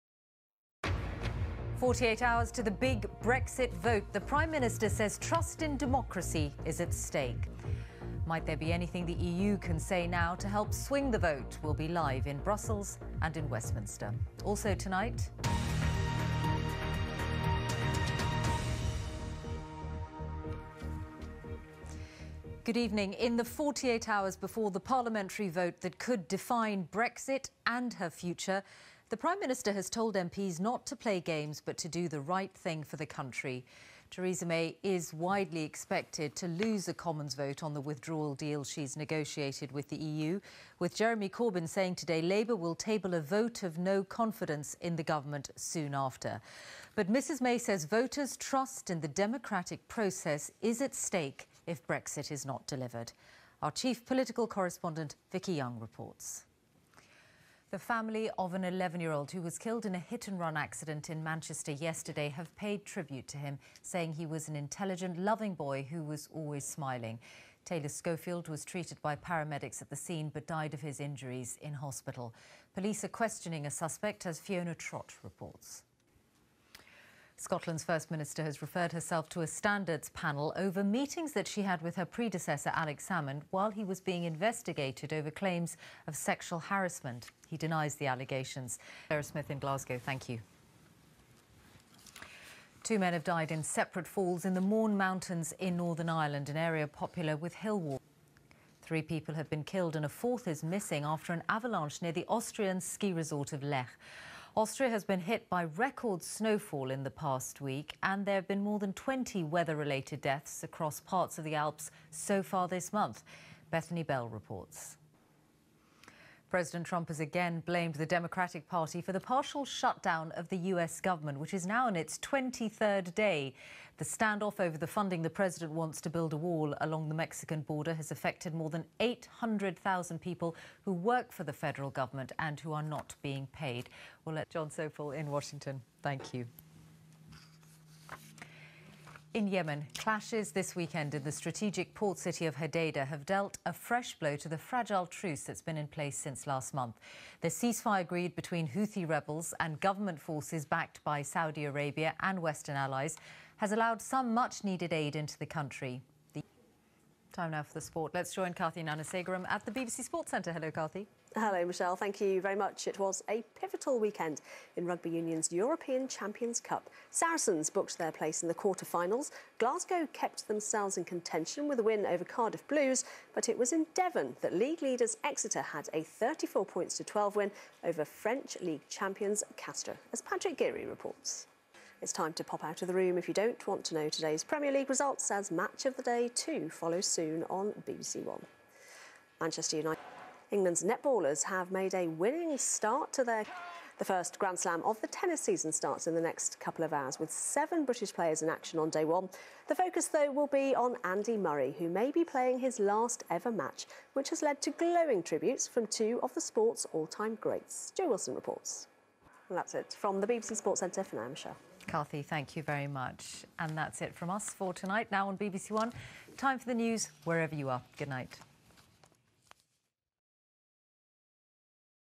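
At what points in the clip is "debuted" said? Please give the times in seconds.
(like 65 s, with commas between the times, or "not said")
not said.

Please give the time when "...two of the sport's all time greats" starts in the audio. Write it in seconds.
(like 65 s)
205 s.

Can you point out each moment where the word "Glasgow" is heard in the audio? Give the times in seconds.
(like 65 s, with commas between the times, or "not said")
89 s, 169 s.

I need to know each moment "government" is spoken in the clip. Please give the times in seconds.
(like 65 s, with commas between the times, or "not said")
45 s, 120 s, 131 s, 149 s.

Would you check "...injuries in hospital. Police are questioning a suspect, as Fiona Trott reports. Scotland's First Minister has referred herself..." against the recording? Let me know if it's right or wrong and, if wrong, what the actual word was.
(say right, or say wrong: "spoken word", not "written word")
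right.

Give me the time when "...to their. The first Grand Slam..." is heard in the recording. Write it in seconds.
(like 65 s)
193 s.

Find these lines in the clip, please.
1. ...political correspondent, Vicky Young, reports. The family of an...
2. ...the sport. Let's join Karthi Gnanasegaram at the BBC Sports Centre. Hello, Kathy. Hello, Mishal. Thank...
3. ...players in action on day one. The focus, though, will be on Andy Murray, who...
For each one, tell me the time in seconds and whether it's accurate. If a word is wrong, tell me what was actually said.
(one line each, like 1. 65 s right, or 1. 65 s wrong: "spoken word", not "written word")
1. 54 s right
2. 157 s right
3. 198 s right.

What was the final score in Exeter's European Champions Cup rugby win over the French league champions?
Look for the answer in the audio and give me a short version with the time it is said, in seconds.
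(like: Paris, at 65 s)
34-12, at 176 s.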